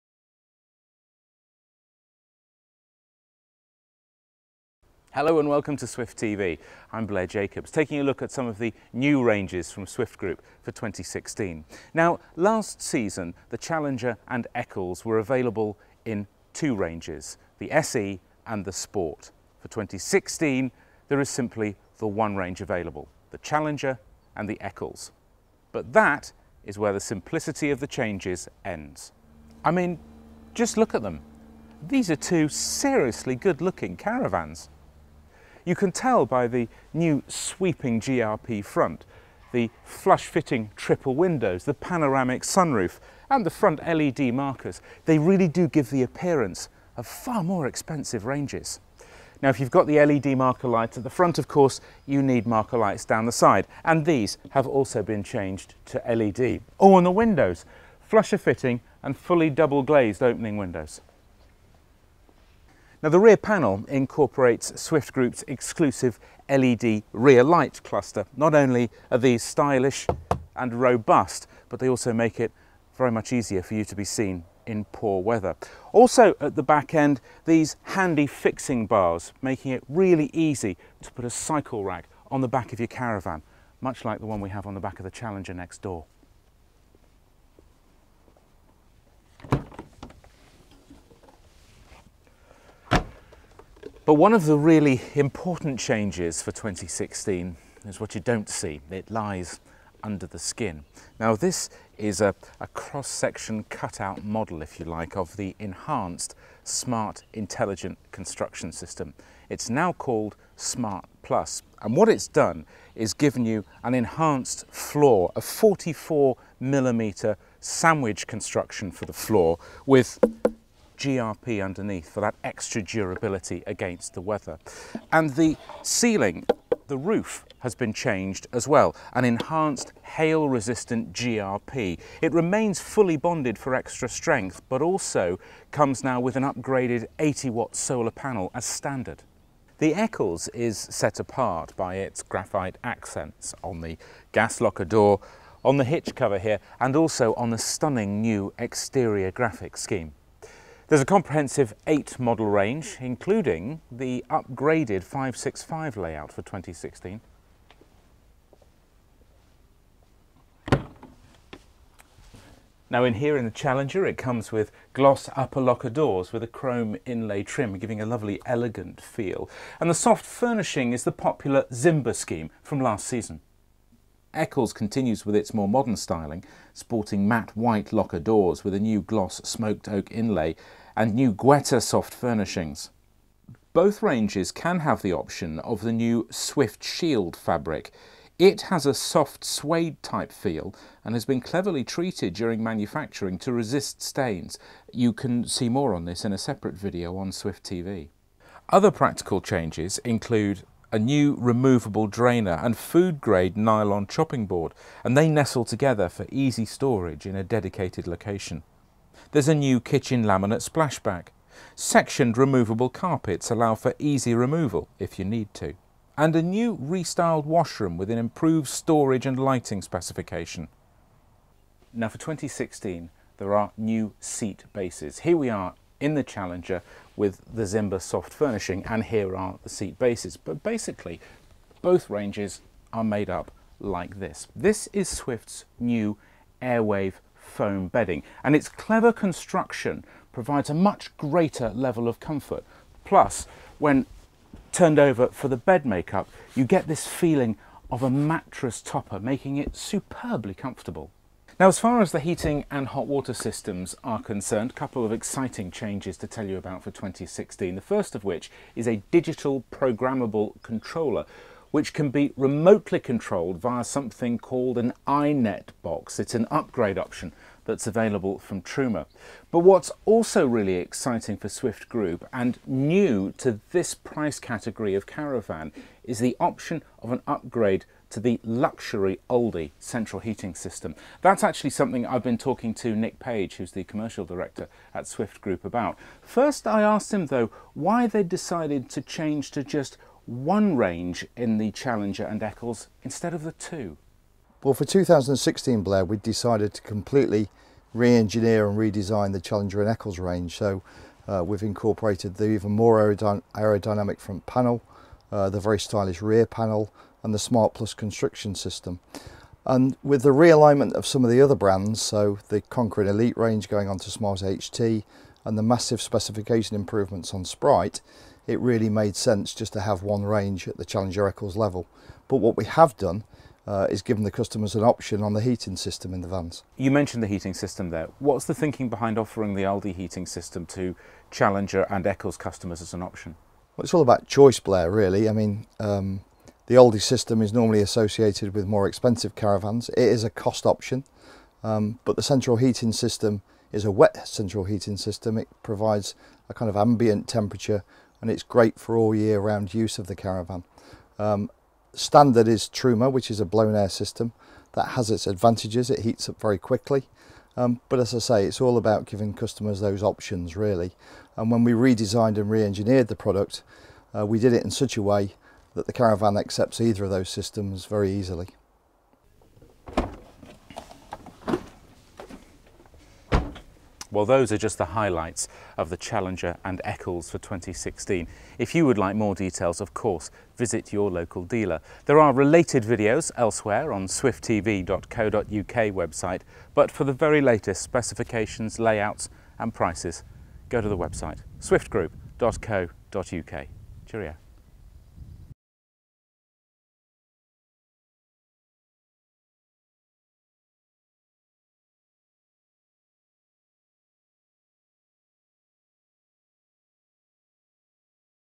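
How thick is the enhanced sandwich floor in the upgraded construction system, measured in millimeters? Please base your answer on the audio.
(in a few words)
44 mm.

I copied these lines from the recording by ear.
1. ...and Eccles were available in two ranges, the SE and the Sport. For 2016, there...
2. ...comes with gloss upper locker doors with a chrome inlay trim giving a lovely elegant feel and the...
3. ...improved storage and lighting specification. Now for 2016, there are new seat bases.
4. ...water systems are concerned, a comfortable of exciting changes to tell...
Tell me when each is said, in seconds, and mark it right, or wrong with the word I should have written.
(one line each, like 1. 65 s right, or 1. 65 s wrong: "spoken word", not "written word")
1. 14 s right
2. 164 s right
3. 218 s right
4. 253 s wrong: "couple", not "comfortable".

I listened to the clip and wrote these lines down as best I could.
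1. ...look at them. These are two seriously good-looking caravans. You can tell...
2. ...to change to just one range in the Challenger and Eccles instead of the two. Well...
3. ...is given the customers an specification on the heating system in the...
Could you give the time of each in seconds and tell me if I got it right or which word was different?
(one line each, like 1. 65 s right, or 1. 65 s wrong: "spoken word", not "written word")
1. 30 s right
2. 288 s right
3. 323 s wrong: "option", not "specification".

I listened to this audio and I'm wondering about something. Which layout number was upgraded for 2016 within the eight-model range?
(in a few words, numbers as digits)
565.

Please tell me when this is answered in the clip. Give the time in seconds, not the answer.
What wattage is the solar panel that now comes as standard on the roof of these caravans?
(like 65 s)
137 s.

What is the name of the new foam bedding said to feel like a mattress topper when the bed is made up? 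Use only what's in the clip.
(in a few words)
Airwave.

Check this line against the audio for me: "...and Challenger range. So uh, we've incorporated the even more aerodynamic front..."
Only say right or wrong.
wrong.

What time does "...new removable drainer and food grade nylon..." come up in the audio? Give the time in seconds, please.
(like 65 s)
200 s.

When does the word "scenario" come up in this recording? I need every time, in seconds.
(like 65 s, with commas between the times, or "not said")
not said.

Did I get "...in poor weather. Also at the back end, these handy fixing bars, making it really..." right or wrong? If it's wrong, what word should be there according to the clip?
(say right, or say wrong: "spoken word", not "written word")
right.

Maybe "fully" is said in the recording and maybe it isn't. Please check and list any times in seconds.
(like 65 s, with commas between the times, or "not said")
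59 s, 132 s.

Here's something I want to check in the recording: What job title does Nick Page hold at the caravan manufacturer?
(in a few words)
Commercial director.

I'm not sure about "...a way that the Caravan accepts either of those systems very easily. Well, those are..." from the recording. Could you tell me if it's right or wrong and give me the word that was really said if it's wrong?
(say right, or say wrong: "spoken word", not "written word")
right.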